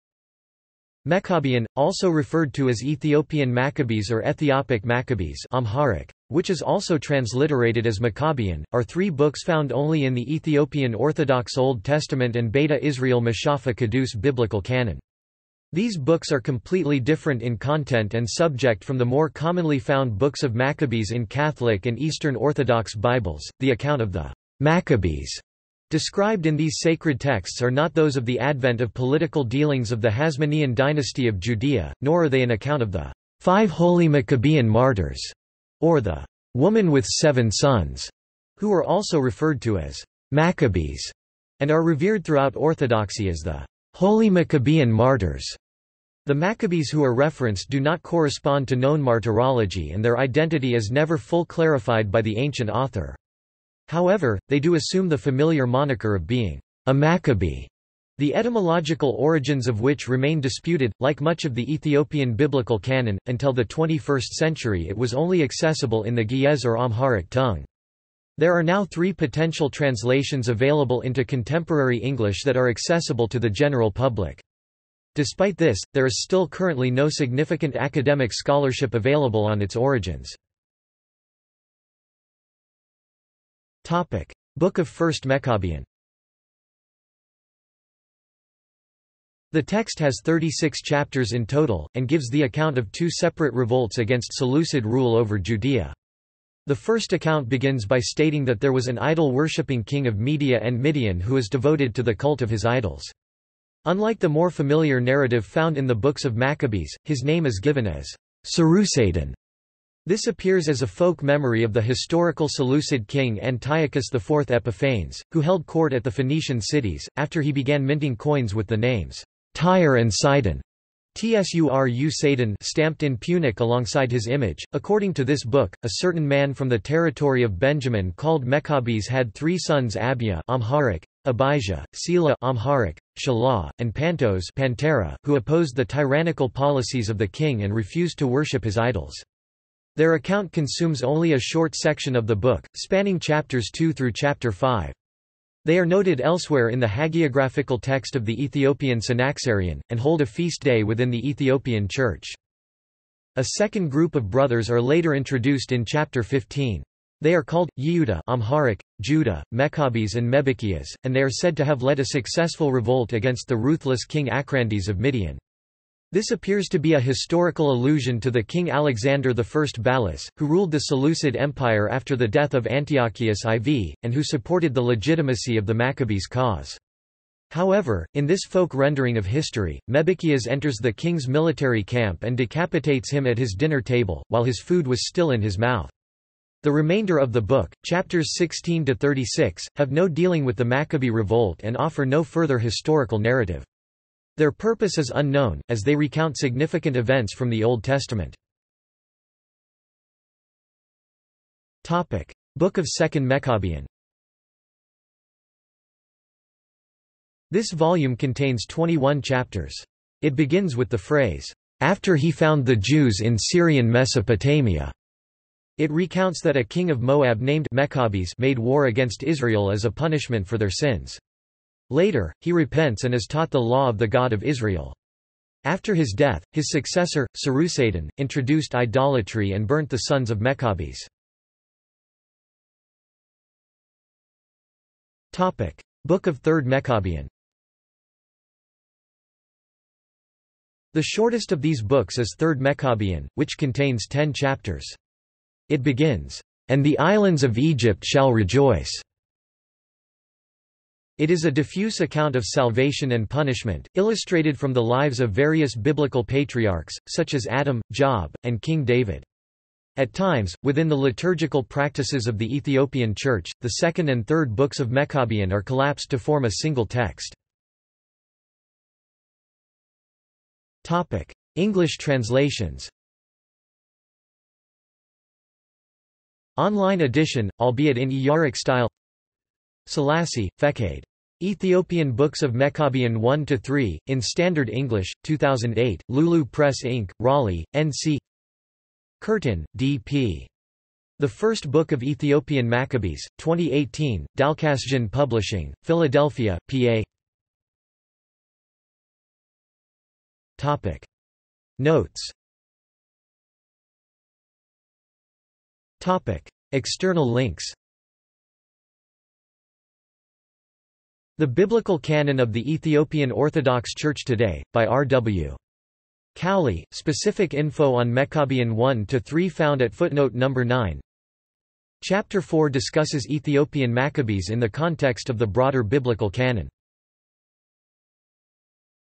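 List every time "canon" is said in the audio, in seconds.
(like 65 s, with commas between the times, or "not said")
14 s, 62 s, 311 s, 326 s.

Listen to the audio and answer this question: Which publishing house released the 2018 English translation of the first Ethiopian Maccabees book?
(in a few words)
Dalcassian Publishing.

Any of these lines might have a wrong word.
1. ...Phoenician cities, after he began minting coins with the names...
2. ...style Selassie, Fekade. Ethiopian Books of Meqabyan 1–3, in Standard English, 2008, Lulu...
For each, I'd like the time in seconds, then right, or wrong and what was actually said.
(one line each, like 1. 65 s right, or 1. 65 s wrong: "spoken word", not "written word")
1. 116 s right
2. 278 s right.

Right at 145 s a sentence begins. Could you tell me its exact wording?
They are noted elsewhere in the hagiographical text of the Ethiopian Synaxarion, and hold a feast day within the Ethiopian Church.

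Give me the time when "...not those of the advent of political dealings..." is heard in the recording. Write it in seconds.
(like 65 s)
27 s.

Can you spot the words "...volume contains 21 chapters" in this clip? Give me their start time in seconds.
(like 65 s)
207 s.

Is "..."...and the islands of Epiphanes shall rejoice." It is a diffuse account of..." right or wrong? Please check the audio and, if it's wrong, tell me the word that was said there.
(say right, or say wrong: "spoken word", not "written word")
wrong: "Egypt", not "Epiphanes".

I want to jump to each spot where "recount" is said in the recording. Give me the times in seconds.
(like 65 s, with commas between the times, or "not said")
195 s, 215 s.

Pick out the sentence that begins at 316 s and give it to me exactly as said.
Cowley, specific info on Meqabyan 1–3 found at footnote number 9.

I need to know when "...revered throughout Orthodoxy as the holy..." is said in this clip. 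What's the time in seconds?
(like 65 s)
41 s.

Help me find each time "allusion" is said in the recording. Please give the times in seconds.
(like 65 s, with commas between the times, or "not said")
167 s.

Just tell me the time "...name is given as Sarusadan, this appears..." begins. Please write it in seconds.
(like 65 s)
107 s.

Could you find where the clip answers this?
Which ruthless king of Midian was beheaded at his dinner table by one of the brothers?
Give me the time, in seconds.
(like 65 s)
164 s.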